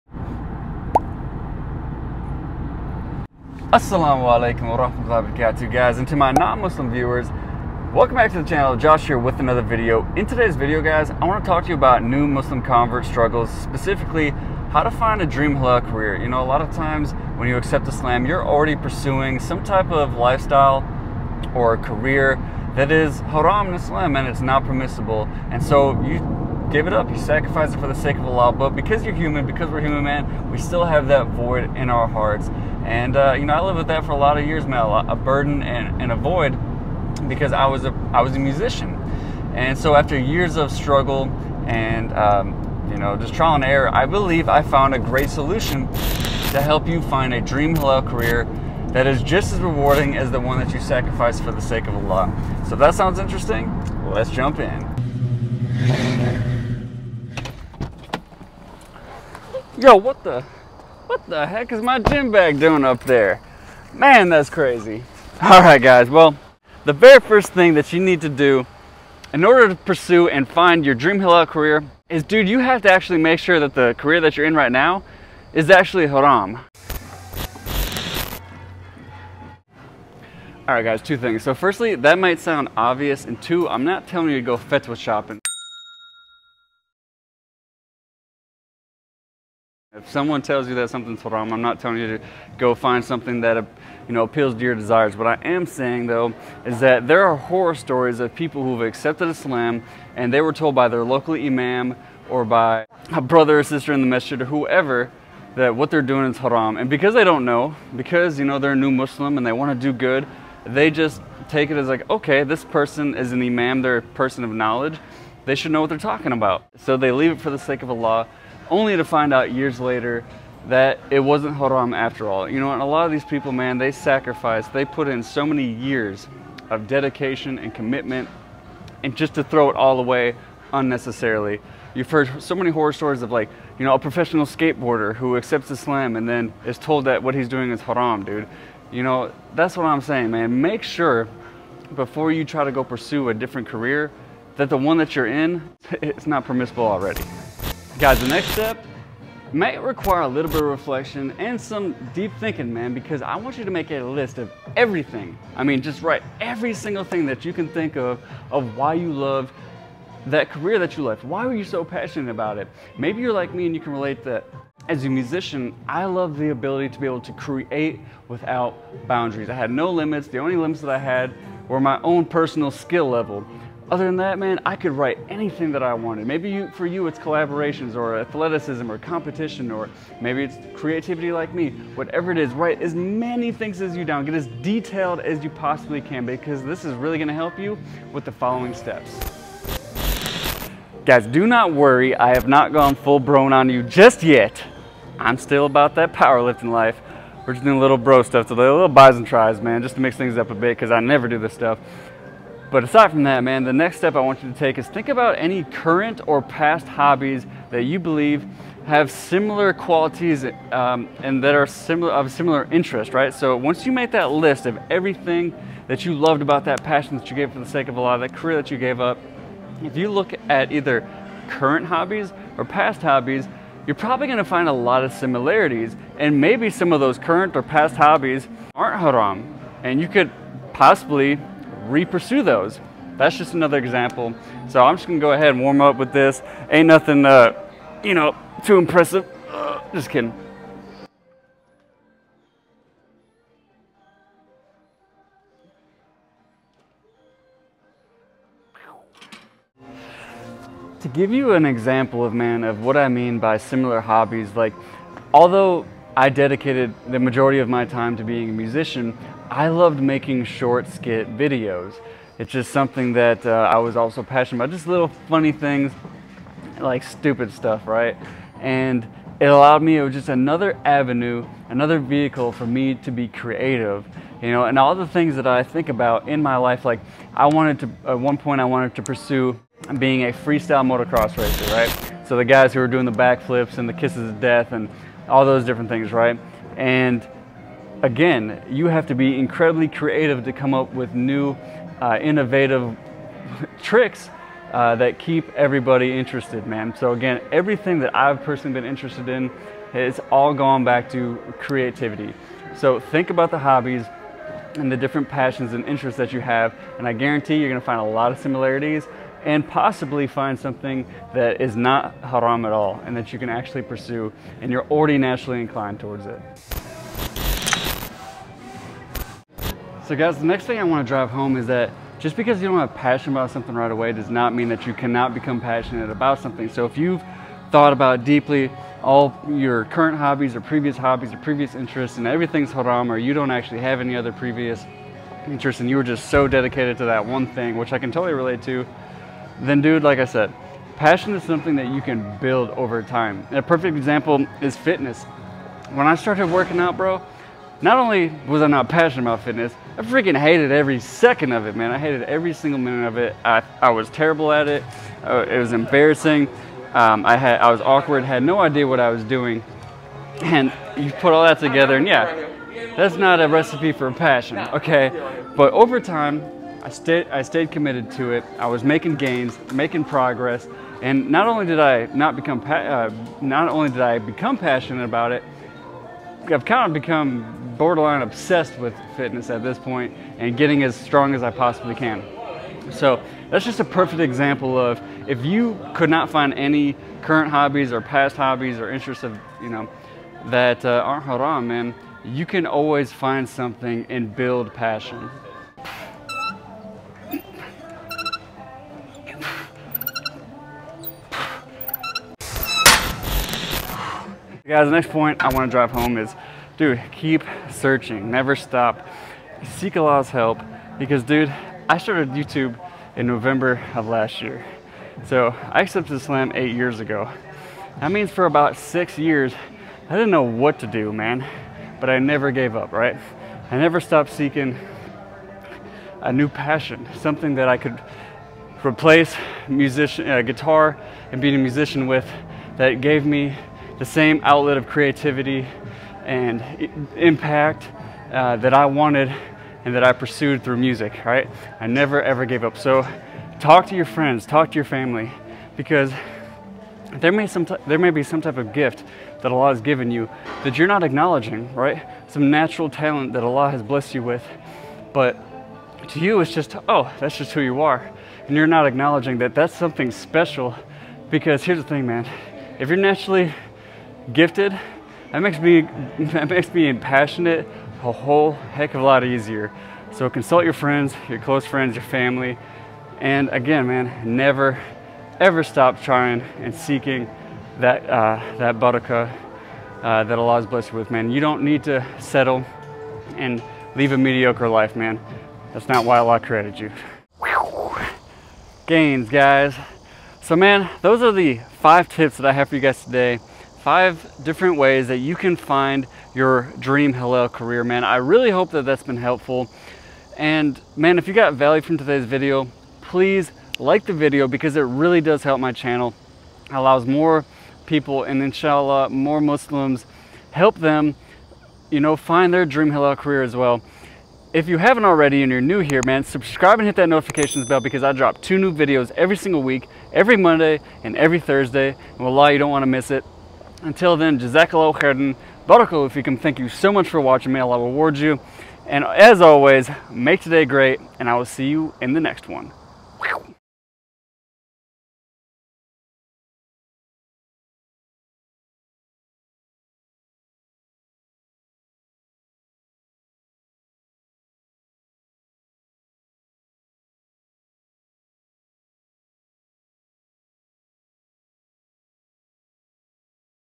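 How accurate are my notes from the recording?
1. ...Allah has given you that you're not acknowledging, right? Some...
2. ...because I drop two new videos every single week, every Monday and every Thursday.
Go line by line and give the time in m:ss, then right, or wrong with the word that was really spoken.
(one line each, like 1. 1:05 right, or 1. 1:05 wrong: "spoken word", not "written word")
1. 7:29 right
2. 8:37 right.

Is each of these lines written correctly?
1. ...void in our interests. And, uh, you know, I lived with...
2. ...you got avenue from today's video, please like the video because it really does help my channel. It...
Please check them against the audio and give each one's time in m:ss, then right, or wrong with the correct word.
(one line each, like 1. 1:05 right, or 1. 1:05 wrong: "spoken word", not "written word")
1. 0:31 wrong: "hearts", not "interests"
2. 8:21 wrong: "value", not "avenue".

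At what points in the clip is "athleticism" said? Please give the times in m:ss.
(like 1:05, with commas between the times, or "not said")
2:58.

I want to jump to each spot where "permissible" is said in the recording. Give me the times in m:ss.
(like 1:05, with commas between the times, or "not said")
0:24, 2:26.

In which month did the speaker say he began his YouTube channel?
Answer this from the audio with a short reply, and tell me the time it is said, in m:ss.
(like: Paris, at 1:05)
November, at 6:53.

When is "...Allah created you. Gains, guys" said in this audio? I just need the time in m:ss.
8:06.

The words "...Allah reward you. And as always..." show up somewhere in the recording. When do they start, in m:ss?
8:47.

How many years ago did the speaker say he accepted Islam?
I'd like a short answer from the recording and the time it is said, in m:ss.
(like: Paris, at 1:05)
8, at 6:56.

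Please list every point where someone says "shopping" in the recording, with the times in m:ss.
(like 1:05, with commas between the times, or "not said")
1:24.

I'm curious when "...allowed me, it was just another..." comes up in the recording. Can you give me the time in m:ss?
4:29.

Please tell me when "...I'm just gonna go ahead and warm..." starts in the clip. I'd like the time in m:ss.
3:54.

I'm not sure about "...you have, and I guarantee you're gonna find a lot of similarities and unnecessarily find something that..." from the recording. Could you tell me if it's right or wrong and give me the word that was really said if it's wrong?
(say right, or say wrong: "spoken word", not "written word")
wrong: "possibly", not "unnecessarily".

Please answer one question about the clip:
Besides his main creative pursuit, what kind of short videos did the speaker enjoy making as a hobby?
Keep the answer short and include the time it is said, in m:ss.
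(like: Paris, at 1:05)
skit videos, at 4:20.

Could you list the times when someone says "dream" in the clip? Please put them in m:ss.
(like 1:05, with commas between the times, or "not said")
0:15, 0:47, 1:10, 8:16, 8:32.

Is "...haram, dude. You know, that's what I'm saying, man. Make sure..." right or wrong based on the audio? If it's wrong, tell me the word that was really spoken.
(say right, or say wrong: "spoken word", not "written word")
right.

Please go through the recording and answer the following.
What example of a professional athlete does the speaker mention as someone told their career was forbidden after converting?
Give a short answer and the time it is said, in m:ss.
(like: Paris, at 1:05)
skateboarder, at 2:13.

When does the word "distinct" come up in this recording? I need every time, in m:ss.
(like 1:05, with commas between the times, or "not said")
not said.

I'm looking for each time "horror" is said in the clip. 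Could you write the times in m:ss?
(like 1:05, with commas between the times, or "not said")
1:37, 2:12.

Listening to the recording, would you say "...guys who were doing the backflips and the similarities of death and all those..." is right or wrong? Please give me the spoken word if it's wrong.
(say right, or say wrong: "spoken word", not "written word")
wrong: "kisses", not "similarities".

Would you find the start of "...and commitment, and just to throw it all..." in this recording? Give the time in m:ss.
2:07.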